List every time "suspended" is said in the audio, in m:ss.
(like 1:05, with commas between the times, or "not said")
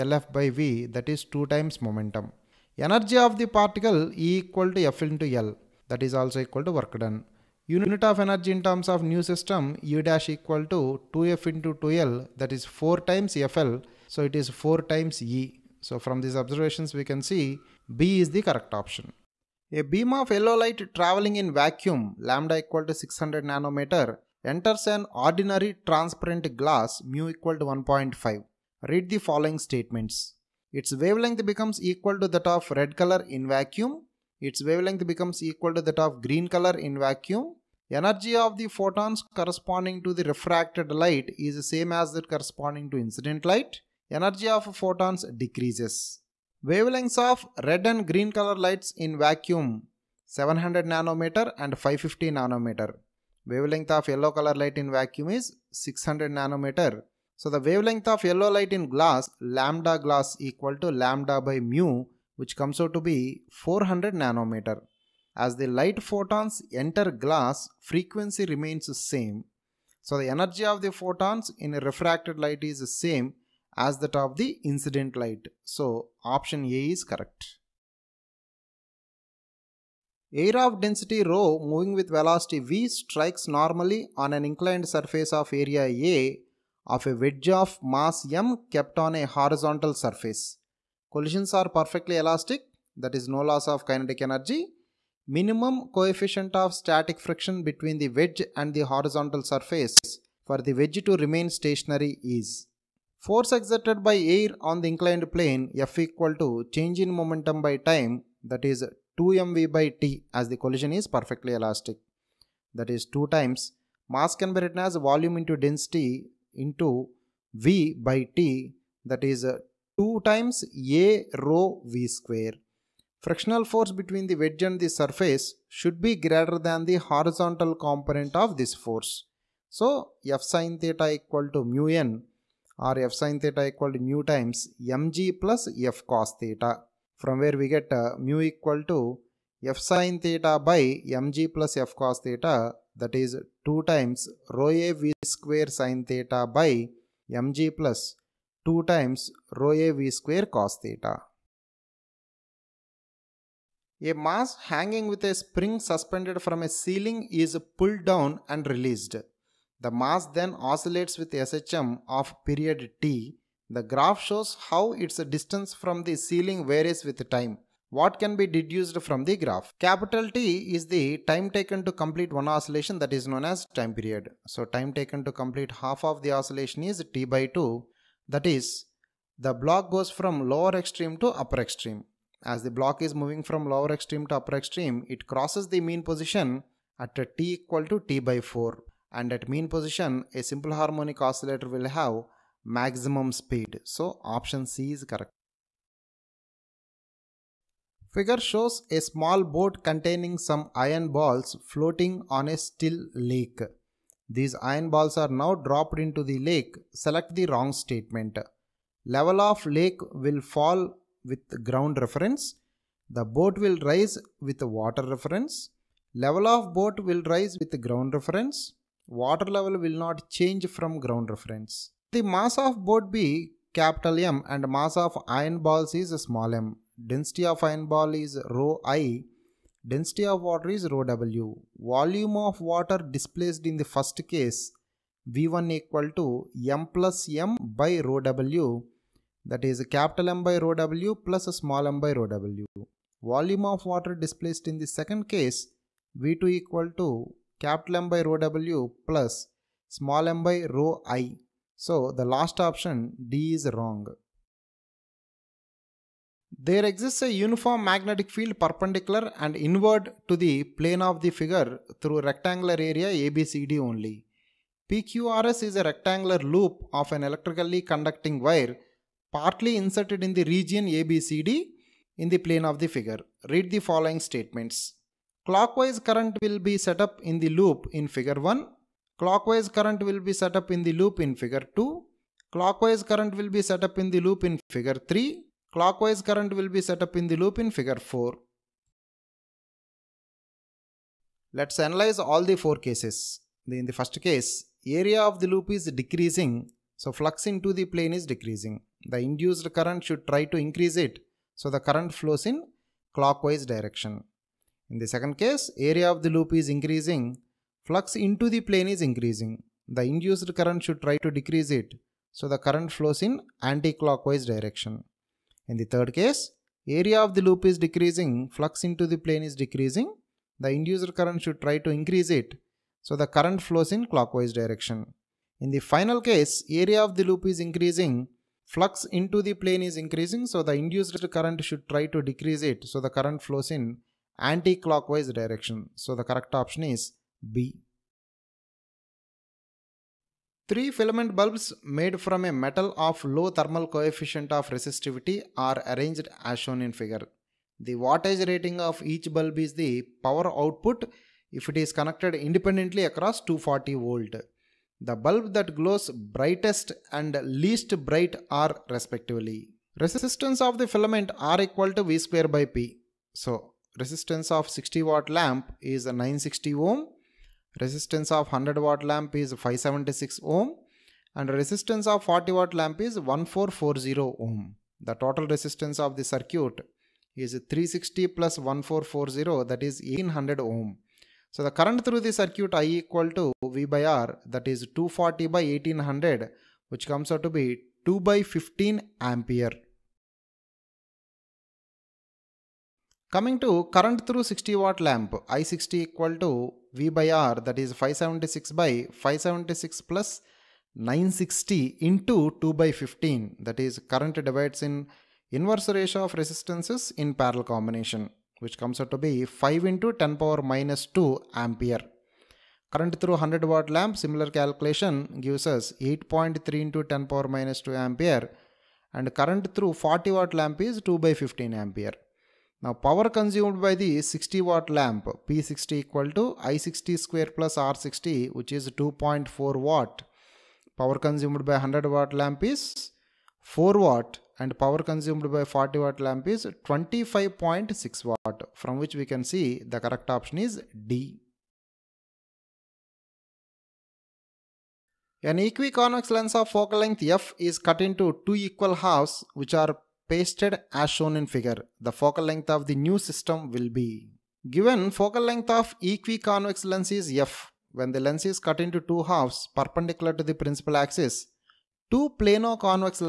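2:35.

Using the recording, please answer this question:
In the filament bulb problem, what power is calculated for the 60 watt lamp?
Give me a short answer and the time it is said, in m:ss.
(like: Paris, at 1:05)
2.4 watts, at 7:09.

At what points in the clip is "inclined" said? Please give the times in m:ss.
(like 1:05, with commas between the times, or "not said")
1:24, 1:44.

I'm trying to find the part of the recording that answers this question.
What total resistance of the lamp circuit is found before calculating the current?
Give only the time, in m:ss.
6:20.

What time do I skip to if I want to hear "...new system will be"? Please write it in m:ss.
7:32.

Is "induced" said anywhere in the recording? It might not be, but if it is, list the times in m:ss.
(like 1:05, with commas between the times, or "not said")
4:59, 5:10, 5:20, 5:30.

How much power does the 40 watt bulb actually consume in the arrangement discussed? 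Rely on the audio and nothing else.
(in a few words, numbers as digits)
25.6 watts.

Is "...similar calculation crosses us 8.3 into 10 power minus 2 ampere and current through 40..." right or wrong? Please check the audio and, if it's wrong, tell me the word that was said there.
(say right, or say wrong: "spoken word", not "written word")
wrong: "gives", not "crosses".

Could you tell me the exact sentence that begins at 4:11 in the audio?
So the last option D is wrong.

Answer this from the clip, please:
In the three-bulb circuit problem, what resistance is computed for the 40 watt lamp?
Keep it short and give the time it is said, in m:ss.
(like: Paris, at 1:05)
1440 ohms, at 6:13.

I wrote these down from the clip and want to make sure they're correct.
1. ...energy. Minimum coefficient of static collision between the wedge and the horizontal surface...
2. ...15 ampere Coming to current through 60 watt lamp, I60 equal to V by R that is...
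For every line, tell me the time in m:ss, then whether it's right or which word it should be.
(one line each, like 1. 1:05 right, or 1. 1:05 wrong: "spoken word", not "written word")
1. 1:34 wrong: "friction", not "collision"
2. 6:28 right.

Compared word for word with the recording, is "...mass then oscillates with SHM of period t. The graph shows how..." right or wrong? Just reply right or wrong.
right.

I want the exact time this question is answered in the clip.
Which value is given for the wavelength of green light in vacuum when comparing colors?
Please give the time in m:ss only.
0:51.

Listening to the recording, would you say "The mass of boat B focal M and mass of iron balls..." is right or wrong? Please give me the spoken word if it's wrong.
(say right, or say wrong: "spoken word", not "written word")
wrong: "capital", not "focal".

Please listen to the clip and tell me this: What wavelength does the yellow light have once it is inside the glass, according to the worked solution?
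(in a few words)
400 nanometers.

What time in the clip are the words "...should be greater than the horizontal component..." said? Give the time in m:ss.
2:05.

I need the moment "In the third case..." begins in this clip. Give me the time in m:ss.
5:15.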